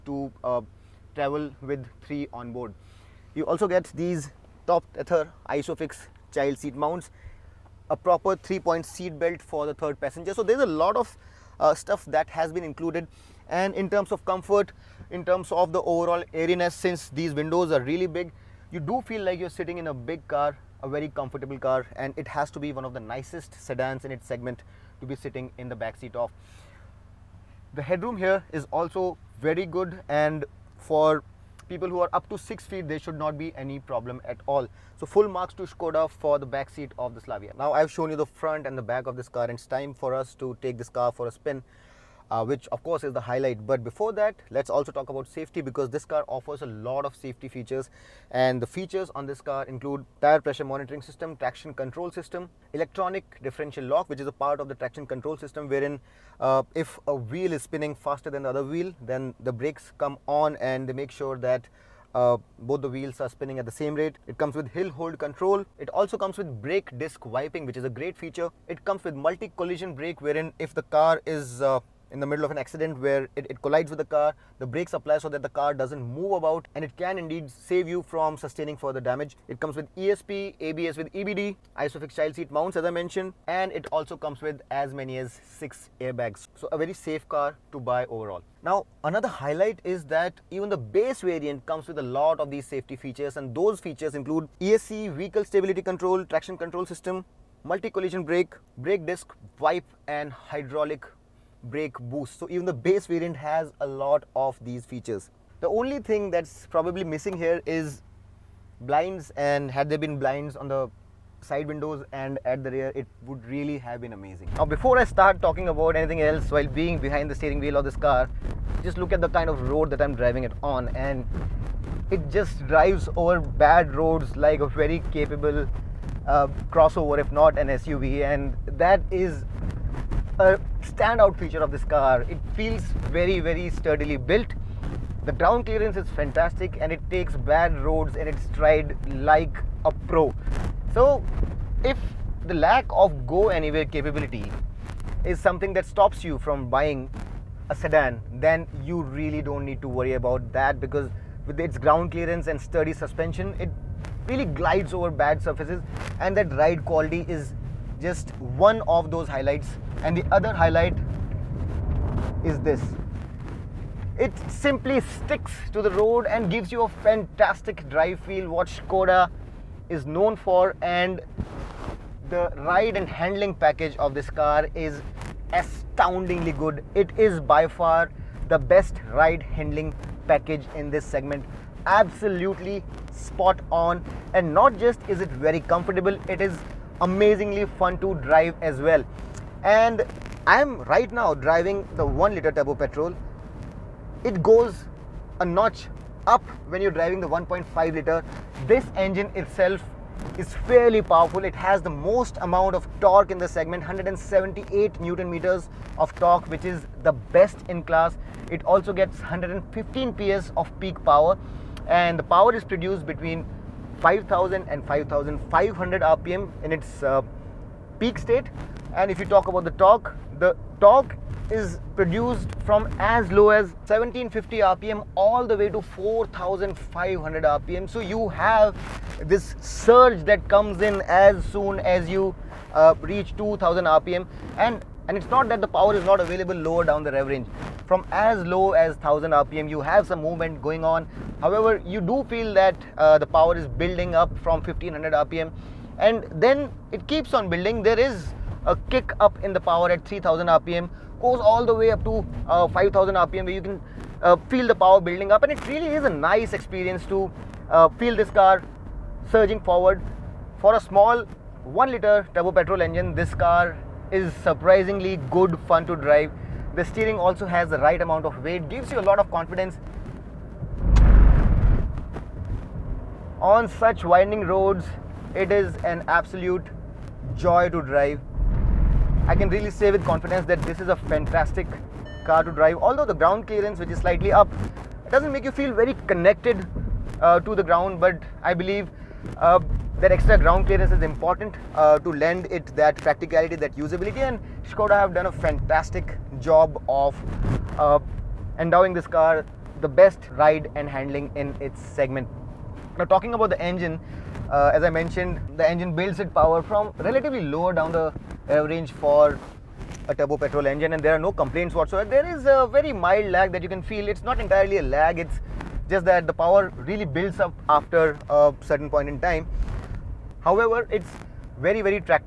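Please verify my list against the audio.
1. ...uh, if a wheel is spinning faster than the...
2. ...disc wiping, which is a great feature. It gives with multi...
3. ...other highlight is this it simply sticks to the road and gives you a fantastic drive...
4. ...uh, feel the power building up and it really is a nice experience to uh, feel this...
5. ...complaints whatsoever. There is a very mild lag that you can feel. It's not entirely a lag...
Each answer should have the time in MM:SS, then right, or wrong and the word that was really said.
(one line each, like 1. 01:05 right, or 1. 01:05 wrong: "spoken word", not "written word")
1. 00:56 right
2. 01:06 wrong: "comes", not "gives"
3. 02:40 right
4. 04:14 right
5. 05:11 right.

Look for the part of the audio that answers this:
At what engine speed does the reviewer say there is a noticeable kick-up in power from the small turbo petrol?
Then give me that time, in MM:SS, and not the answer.
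04:10.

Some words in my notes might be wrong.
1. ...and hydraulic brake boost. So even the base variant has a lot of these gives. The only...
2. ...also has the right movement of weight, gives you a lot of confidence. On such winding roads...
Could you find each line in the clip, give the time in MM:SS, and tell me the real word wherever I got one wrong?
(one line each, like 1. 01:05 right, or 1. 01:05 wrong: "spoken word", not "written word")
1. 01:40 wrong: "features", not "gives"
2. 04:27 wrong: "amount", not "movement".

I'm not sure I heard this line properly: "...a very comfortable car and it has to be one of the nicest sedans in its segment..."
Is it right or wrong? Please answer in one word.
right.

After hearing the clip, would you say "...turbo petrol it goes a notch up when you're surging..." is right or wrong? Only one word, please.
wrong.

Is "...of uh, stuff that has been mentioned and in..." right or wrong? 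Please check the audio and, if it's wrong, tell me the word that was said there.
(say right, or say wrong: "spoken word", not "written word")
wrong: "included", not "mentioned".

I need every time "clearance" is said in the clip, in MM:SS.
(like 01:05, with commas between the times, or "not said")
02:15, 02:32, 04:43, 04:50.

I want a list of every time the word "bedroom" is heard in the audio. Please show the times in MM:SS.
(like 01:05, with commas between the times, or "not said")
not said.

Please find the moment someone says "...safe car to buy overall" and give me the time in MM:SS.
01:26.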